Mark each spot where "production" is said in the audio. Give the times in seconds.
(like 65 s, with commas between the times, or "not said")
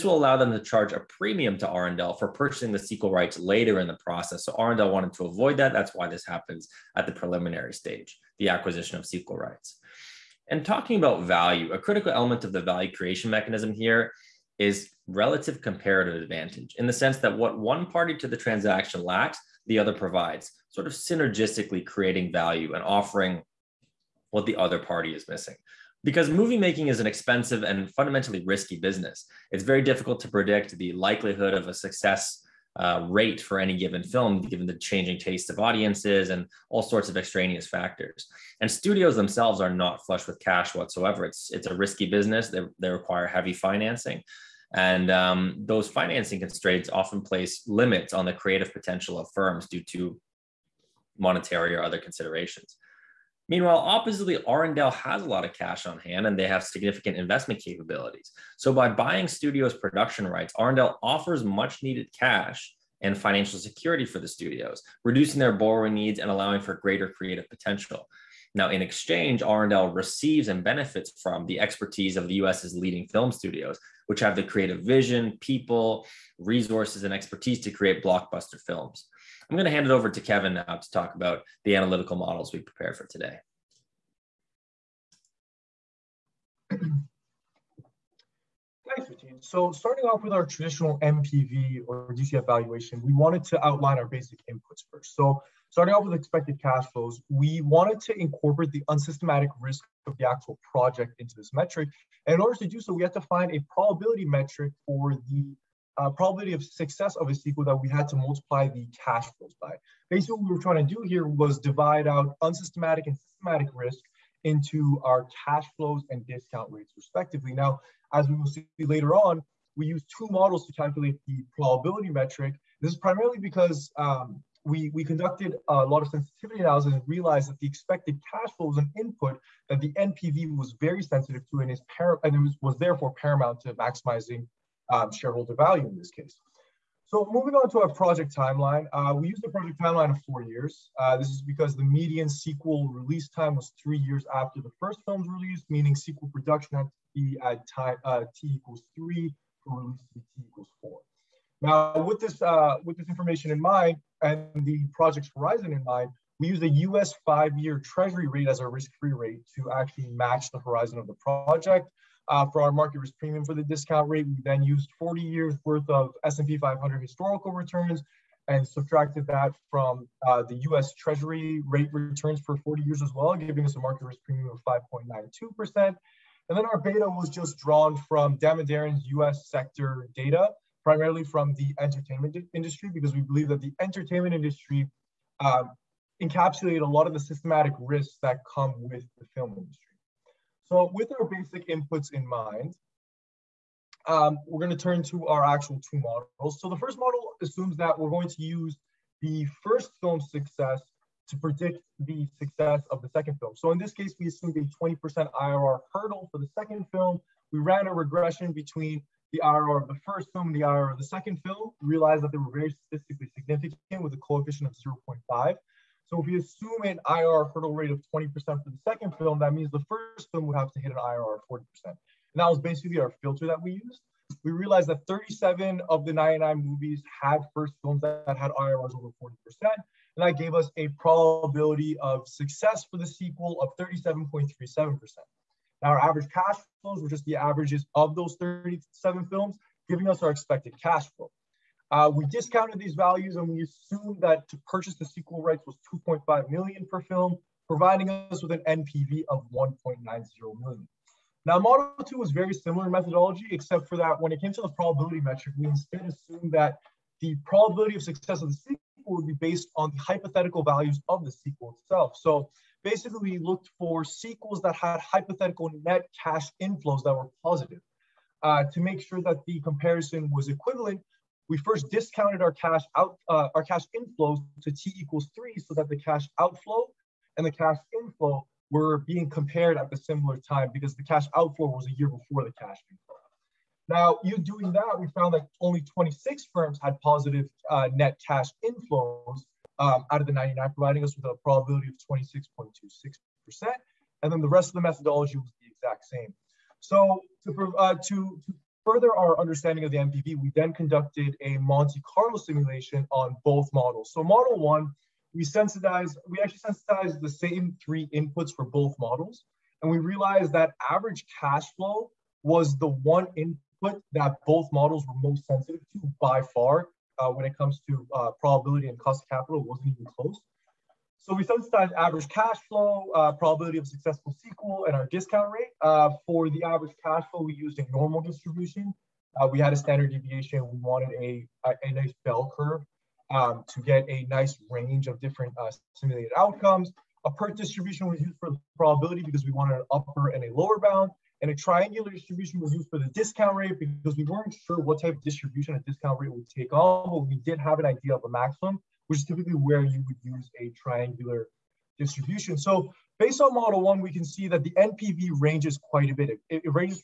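59 s, 146 s.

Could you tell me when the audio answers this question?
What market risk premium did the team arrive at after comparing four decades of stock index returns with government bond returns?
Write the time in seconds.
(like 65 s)
174 s.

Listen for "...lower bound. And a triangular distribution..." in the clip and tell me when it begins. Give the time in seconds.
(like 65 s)
340 s.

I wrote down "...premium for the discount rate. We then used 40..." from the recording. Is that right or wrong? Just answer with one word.
right.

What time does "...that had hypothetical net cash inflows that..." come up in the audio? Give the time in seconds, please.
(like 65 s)
264 s.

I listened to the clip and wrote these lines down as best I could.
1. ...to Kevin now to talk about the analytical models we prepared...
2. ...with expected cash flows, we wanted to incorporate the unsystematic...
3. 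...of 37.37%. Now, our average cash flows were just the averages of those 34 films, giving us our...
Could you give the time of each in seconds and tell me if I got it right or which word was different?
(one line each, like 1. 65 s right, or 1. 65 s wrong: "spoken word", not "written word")
1. 80 s right
2. 96 s right
3. 233 s wrong: "37", not "34".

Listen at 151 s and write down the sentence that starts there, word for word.
Now, with this uh, with this information in mind and the project's horizon in mind, we use a U.S.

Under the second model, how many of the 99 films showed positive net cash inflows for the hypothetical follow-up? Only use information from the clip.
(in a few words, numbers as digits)
26.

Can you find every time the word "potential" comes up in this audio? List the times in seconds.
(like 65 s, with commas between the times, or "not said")
48 s, 67 s.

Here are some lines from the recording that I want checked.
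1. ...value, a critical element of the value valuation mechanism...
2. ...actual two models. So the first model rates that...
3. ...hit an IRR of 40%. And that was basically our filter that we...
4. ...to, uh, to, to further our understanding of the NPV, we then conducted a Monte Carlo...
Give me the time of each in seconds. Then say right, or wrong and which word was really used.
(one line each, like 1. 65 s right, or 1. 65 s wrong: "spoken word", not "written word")
1. 11 s wrong: "creation", not "valuation"
2. 195 s wrong: "assumes", not "rates"
3. 220 s right
4. 297 s right.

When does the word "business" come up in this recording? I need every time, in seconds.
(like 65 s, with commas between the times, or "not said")
28 s, 42 s.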